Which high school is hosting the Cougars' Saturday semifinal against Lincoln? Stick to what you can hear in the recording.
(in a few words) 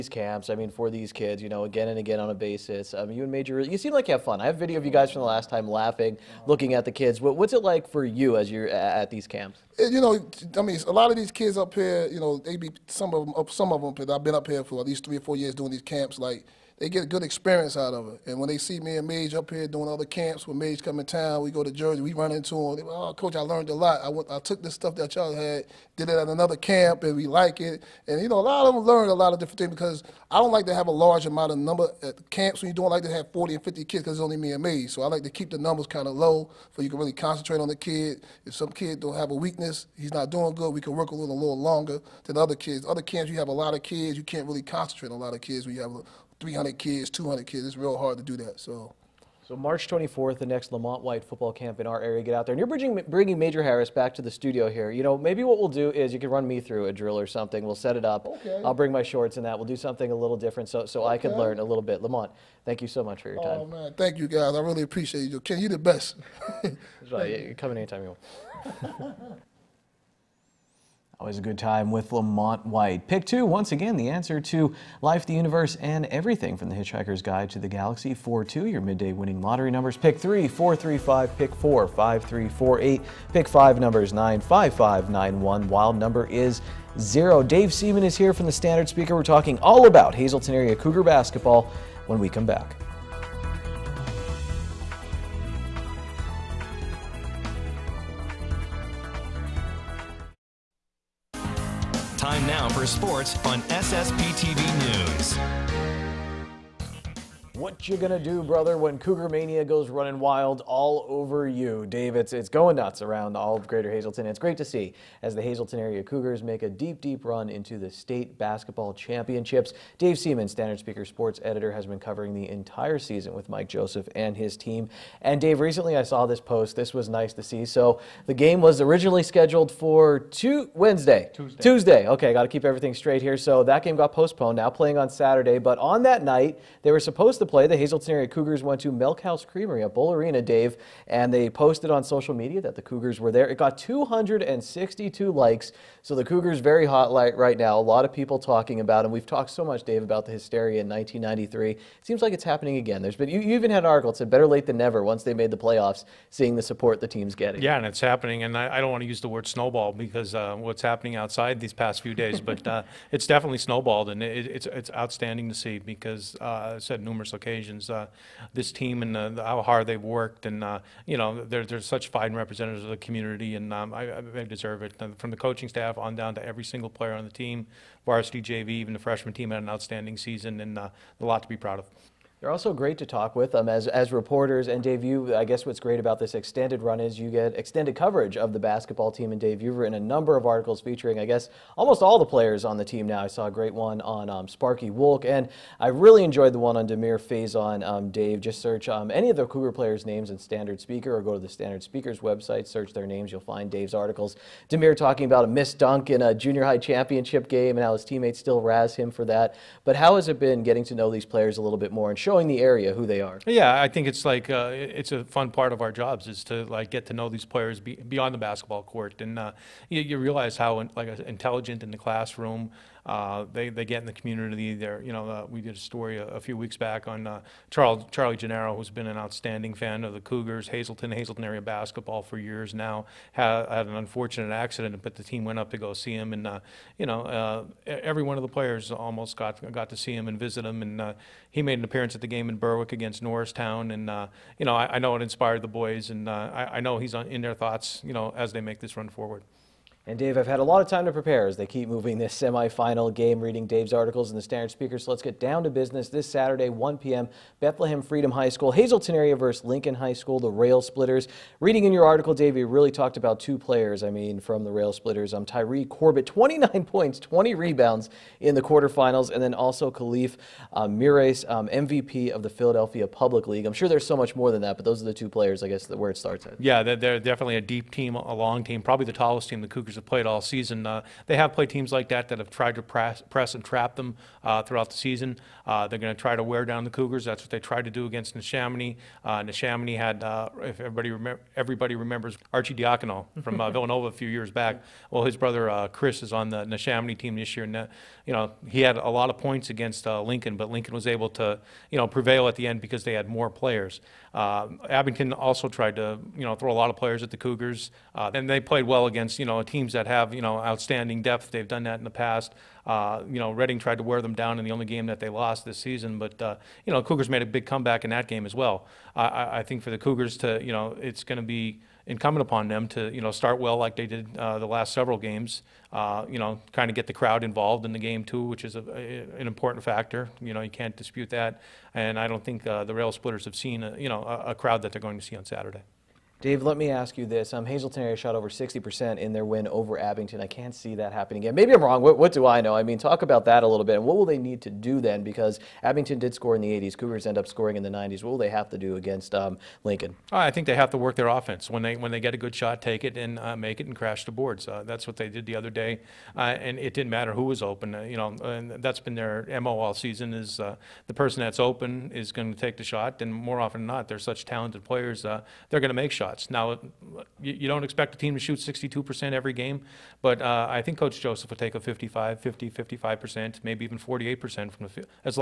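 Bethlehem Freedom High School.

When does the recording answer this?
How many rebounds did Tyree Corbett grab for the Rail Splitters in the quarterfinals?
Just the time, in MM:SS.
04:27.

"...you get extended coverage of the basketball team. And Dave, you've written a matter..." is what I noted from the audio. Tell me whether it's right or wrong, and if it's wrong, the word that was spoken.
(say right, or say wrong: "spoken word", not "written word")
wrong: "number", not "matter".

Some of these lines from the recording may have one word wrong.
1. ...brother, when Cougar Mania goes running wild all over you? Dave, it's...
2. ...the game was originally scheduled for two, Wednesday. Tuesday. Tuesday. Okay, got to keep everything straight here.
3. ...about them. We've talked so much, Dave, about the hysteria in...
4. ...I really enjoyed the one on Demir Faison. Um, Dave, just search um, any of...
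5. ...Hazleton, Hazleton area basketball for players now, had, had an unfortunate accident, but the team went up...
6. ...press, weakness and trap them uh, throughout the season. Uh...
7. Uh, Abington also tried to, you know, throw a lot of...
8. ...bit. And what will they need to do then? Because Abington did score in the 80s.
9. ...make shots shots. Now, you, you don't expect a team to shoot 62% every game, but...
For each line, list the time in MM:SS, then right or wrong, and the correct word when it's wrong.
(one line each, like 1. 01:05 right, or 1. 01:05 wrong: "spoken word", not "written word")
1. 01:48 right
2. 02:08 right
3. 02:28 right
4. 03:15 right
5. 03:50 wrong: "years", not "players"
6. 04:42 wrong: "press", not "weakness"
7. 05:04 right
8. 05:43 right
9. 06:05 right.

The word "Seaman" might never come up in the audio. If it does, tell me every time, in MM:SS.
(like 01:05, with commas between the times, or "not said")
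01:27, 02:00.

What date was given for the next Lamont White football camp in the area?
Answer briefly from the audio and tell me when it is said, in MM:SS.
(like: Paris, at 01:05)
March 24th, at 00:49.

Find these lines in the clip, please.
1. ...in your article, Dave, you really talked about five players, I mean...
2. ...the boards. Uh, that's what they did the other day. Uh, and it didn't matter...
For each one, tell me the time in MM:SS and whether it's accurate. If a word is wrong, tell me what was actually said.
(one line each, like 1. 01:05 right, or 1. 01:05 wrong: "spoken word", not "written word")
1. 04:21 wrong: "two", not "five"
2. 05:54 right.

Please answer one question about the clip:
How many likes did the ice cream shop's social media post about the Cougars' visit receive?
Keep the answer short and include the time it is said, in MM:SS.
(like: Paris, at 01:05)
262, at 02:23.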